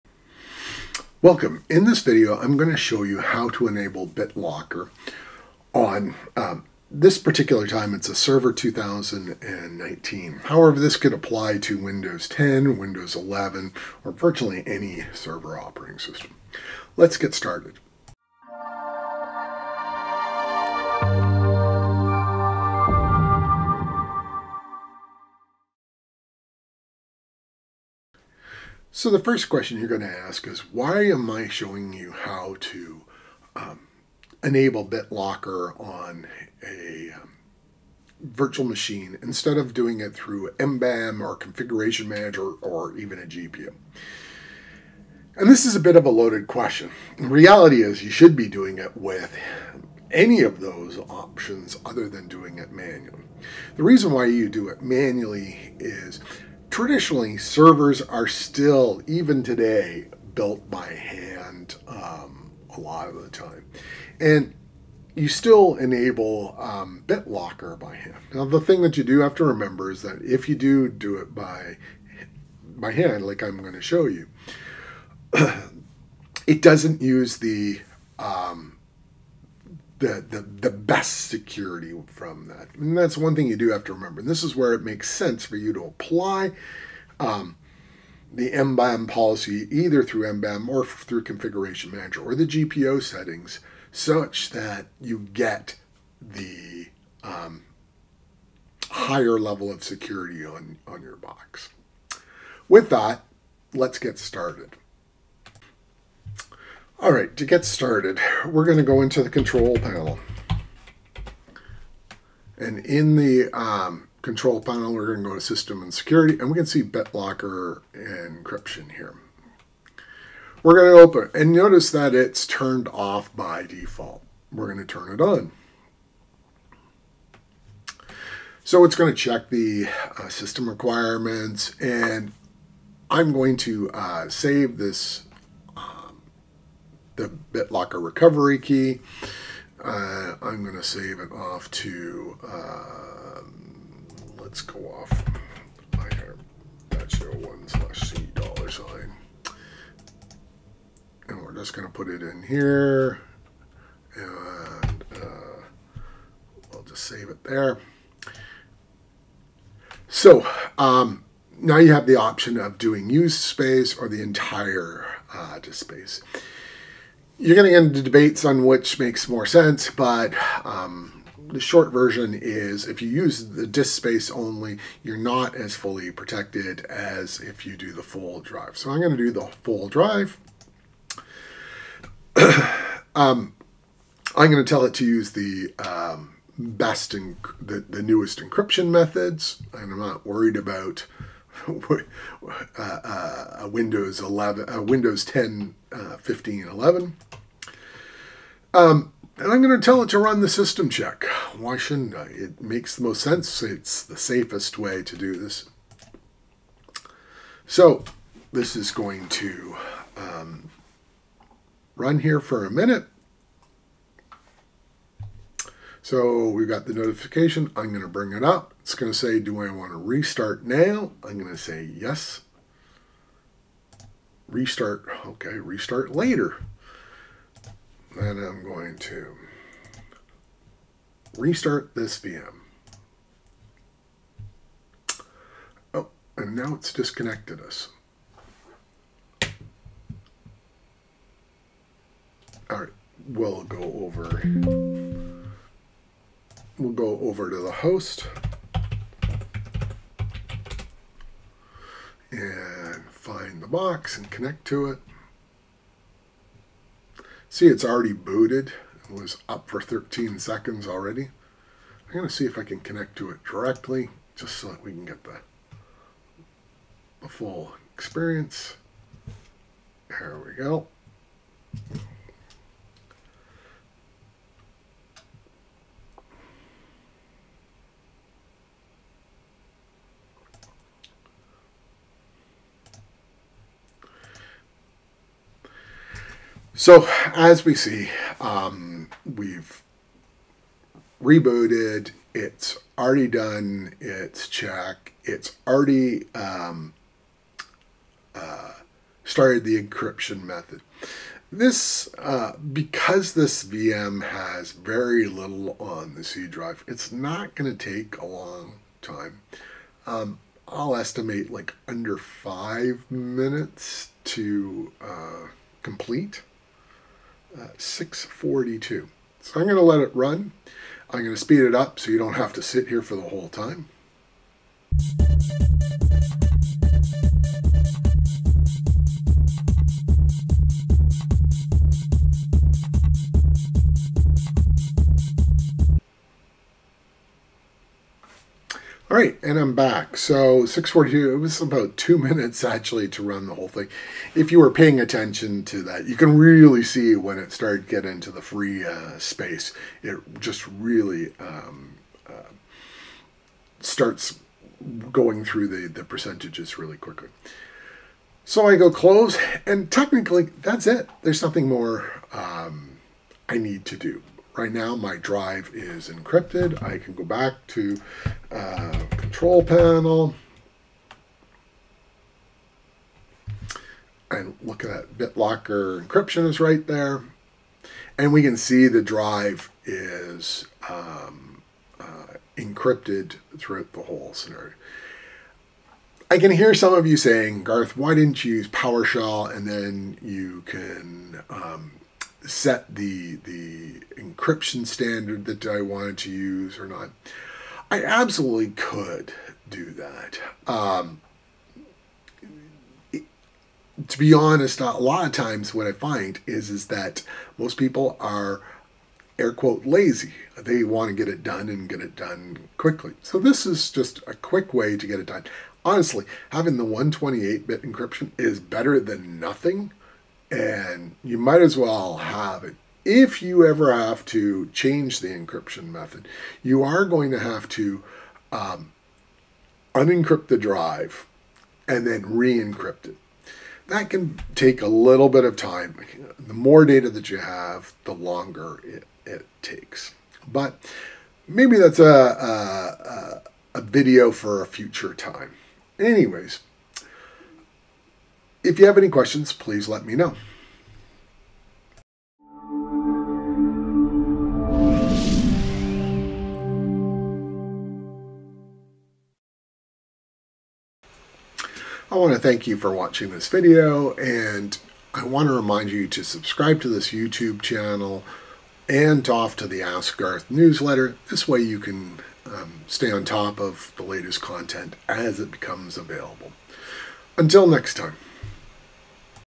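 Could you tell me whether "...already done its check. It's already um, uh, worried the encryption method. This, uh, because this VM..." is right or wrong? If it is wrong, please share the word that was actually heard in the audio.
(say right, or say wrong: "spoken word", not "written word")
wrong: "started", not "worried".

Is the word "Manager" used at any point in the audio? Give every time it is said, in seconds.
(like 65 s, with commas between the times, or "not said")
42 s, 91 s.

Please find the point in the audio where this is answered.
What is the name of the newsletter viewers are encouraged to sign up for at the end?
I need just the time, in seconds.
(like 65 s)
469 s.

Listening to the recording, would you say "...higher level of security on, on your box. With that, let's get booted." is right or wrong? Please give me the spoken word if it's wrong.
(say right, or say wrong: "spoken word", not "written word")
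wrong: "started", not "booted".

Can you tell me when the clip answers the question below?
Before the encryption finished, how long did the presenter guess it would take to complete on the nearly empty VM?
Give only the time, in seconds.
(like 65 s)
311 s.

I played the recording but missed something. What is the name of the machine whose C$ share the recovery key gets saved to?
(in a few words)
IR-01.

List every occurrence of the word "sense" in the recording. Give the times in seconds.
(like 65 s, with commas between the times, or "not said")
85 s, 169 s, 203 s.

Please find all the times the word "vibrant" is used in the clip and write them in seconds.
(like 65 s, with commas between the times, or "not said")
not said.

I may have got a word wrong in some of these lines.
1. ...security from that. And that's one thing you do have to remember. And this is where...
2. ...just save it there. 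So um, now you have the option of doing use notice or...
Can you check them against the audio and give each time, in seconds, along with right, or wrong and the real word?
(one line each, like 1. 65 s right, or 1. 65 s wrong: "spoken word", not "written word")
1. 81 s right
2. 156 s wrong: "space", not "notice".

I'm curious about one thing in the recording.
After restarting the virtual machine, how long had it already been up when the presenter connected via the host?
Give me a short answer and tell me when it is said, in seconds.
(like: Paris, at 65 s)
13 seconds, at 259 s.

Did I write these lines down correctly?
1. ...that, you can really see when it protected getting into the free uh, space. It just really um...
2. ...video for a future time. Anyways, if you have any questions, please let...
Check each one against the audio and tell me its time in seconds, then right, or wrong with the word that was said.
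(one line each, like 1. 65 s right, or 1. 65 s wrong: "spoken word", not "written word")
1. 345 s wrong: "started", not "protected"
2. 443 s right.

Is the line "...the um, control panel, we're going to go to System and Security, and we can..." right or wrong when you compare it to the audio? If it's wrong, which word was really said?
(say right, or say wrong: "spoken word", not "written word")
right.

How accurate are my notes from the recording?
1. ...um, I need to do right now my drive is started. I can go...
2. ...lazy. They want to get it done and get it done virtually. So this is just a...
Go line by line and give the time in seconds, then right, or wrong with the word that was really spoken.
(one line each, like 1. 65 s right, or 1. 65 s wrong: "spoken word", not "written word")
1. 362 s wrong: "encrypted", not "started"
2. 409 s wrong: "quickly", not "virtually".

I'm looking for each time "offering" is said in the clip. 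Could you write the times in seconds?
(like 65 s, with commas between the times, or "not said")
not said.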